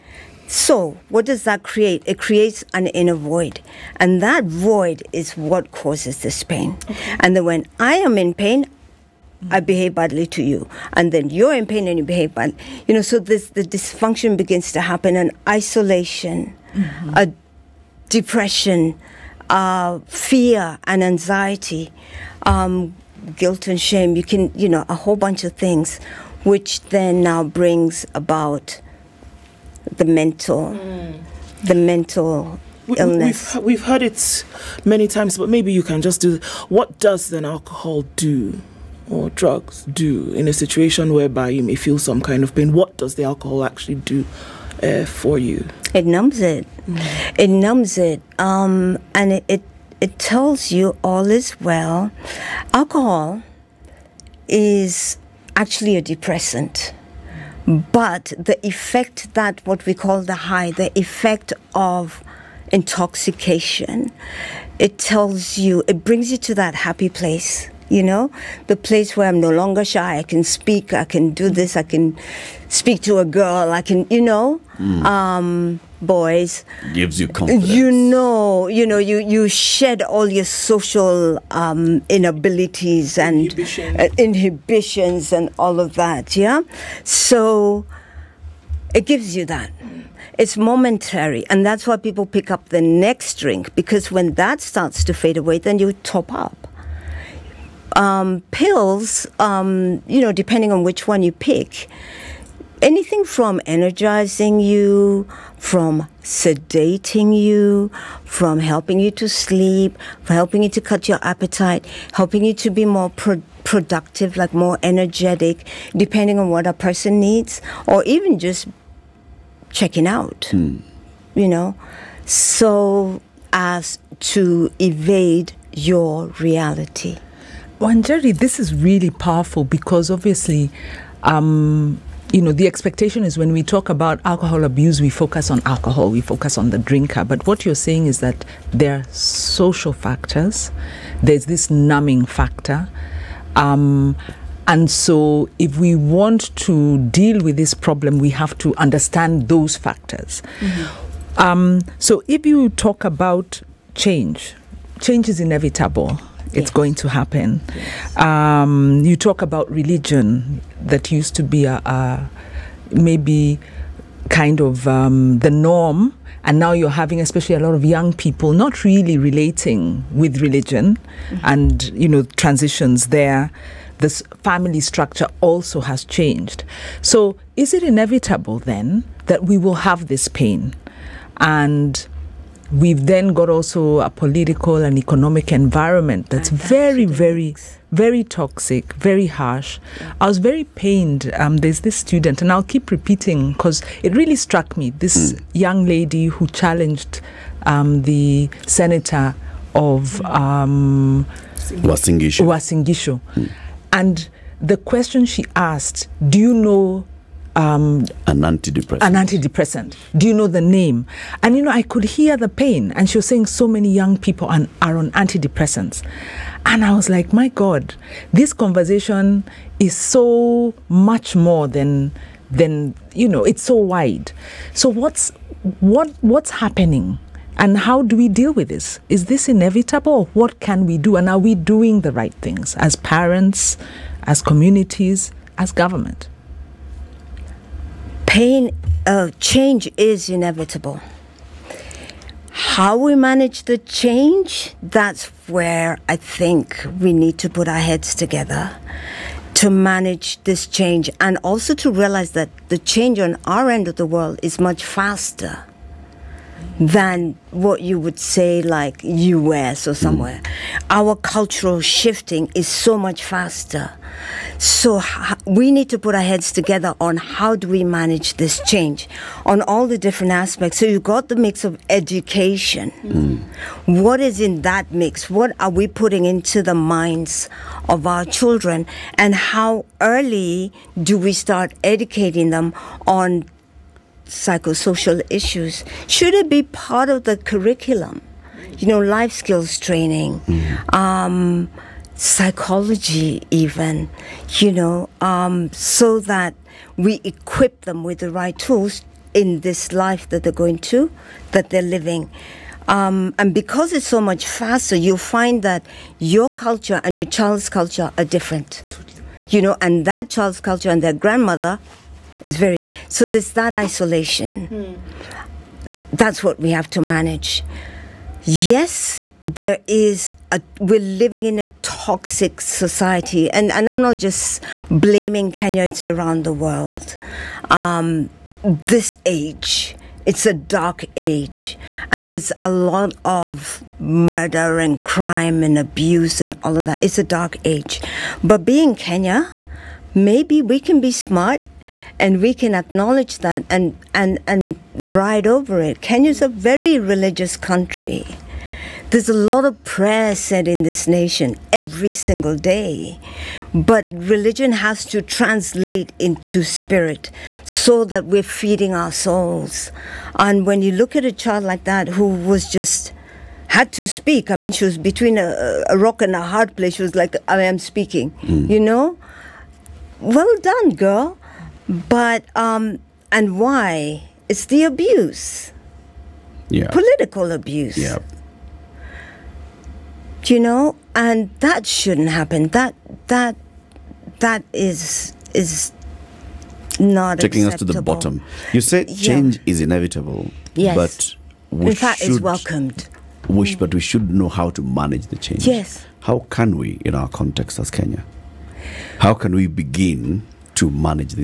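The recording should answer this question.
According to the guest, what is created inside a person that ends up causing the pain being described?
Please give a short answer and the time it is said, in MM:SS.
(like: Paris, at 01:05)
An inner void, at 00:02.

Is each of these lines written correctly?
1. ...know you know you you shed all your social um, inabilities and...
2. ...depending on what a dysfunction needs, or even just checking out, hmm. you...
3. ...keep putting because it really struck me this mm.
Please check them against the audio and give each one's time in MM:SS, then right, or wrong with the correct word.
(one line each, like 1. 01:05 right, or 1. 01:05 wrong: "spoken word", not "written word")
1. 01:17 right
2. 01:55 wrong: "person", not "dysfunction"
3. 03:12 wrong: "repeating", not "putting".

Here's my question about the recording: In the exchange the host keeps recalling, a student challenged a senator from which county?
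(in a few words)
Uasin Gishu.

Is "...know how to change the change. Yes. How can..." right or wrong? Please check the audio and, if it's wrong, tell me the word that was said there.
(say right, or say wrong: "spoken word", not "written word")
wrong: "manage", not "change".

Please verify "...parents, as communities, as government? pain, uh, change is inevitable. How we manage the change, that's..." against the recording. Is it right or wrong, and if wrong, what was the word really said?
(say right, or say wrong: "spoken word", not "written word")
right.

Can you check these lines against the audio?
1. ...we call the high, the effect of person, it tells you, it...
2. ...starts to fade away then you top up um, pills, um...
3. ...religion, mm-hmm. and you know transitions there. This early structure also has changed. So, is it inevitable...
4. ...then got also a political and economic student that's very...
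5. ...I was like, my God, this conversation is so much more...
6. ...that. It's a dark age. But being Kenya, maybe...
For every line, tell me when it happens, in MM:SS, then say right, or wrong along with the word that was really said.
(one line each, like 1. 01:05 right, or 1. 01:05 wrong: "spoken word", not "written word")
1. 00:59 wrong: "intoxication", not "person"
2. 01:34 right
3. 02:50 wrong: "family", not "early"
4. 03:03 wrong: "environment", not "student"
5. 03:36 right
6. 05:36 right.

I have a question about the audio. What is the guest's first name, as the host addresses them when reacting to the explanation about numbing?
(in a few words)
Jerry.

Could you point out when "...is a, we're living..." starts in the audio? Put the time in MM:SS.
05:19.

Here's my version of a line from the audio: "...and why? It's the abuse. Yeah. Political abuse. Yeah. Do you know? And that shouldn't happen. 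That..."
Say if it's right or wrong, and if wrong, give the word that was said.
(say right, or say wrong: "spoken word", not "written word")
right.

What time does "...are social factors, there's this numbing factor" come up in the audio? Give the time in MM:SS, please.
02:18.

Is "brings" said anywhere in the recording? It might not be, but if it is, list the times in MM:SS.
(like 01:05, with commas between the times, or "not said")
00:27, 01:06.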